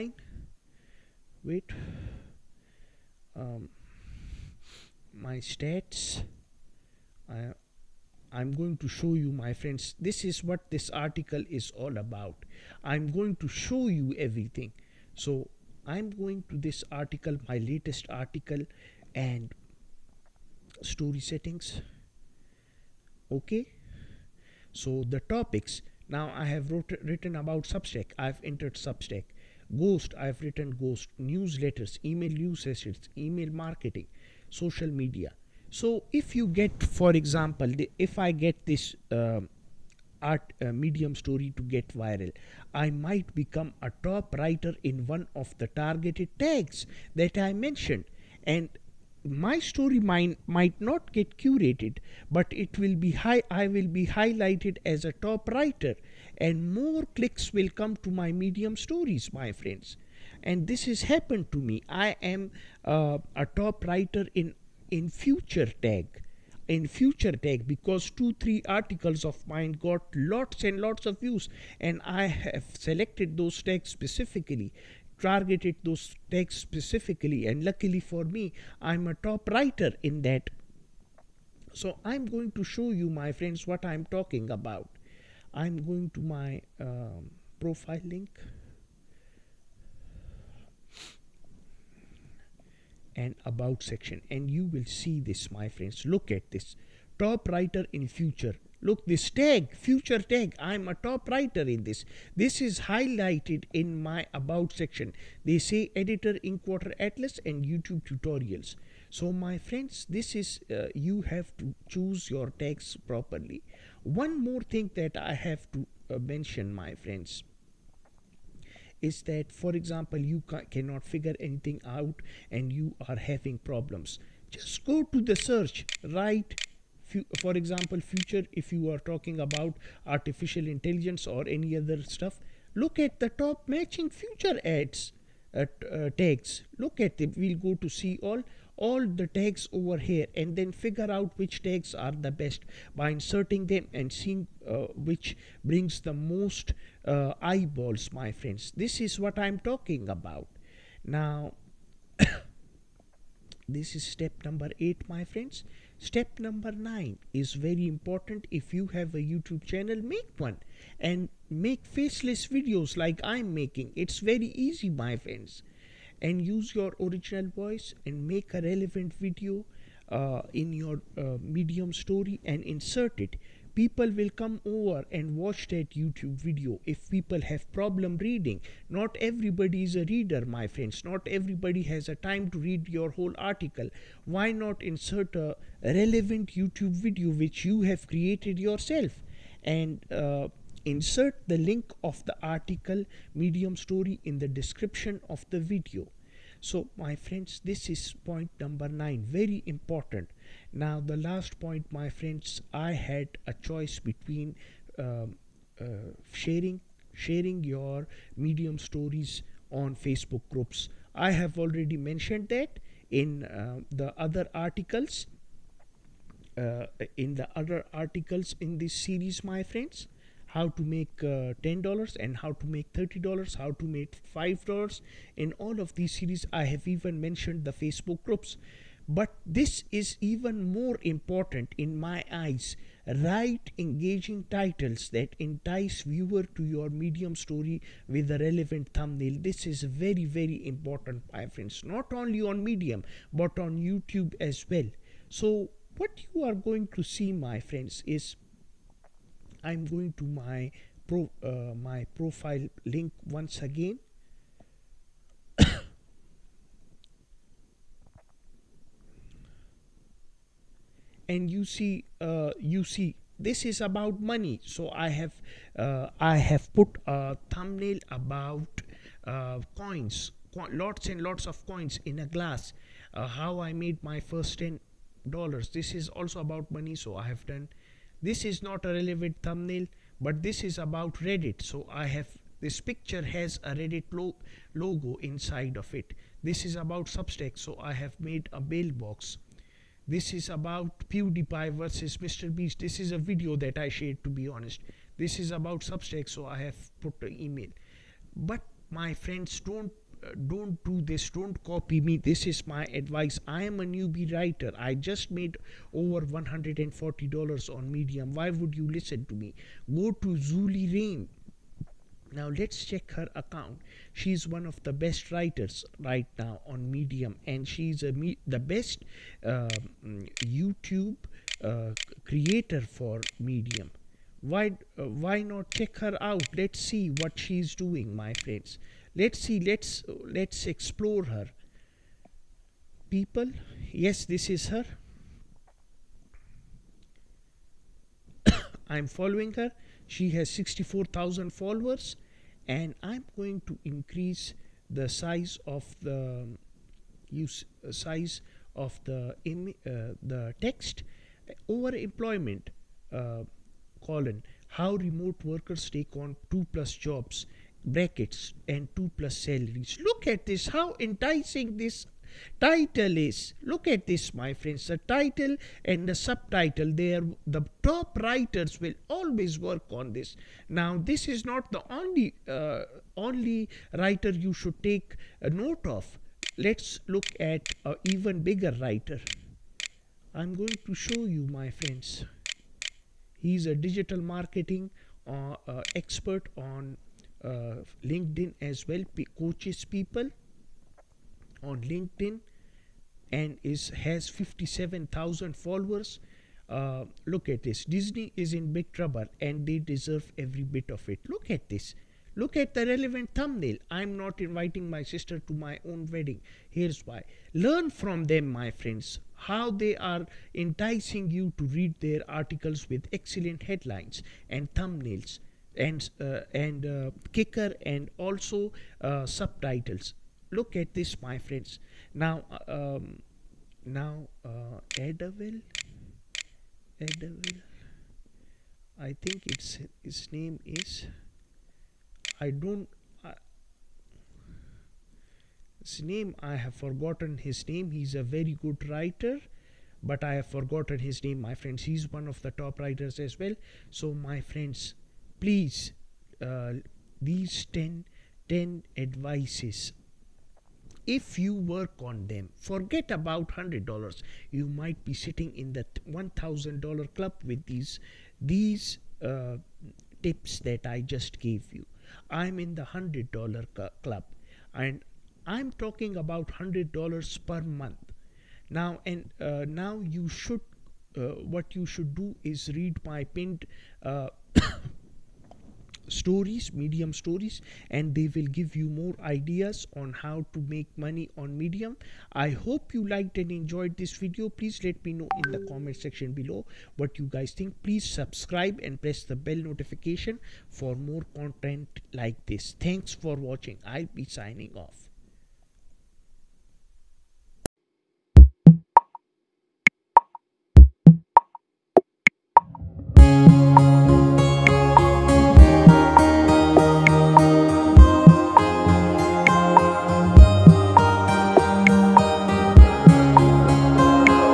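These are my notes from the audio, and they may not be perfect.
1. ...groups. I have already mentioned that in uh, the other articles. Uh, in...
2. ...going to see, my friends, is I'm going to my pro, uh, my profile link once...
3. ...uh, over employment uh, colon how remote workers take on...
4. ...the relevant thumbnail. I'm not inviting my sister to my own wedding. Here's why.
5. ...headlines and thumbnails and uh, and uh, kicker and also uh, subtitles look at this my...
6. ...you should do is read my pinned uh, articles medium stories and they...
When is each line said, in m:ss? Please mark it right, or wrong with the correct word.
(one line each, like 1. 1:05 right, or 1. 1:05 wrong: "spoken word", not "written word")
1. 3:30 right
2. 4:06 right
3. 5:51 right
4. 6:42 right
5. 6:53 right
6. 7:51 wrong: "stories", not "articles".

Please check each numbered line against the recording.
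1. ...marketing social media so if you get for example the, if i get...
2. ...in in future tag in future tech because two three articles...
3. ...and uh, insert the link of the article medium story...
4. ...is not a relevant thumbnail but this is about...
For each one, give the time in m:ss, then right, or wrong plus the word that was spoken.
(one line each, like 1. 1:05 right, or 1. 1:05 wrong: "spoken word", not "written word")
1. 0:33 right
2. 1:04 right
3. 3:09 right
4. 4:38 right.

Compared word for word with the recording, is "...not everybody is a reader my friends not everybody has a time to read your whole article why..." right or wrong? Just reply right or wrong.
right.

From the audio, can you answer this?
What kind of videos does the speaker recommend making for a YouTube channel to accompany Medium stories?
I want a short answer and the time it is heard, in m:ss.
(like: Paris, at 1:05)
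Faceless videos, at 2:41.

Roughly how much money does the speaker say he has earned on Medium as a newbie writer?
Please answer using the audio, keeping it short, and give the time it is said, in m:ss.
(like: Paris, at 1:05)
Over $140, at 5:05.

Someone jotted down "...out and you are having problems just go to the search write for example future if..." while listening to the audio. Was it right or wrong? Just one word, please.
right.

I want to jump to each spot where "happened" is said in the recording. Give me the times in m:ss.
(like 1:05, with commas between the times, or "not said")
1:01.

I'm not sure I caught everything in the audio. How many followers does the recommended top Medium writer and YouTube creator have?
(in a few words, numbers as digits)
64,000.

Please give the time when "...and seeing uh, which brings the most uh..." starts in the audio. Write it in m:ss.
2:23.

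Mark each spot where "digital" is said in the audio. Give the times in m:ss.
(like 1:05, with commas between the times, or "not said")
6:23.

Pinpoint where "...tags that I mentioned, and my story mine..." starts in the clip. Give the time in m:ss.
0:46.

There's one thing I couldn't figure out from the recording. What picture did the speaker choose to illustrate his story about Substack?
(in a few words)
A mailbox.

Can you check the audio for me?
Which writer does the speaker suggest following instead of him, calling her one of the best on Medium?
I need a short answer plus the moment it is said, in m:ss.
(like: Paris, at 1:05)
Zulie Rane, at 5:10.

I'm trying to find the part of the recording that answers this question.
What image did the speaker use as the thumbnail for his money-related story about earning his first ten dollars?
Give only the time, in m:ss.
4:31.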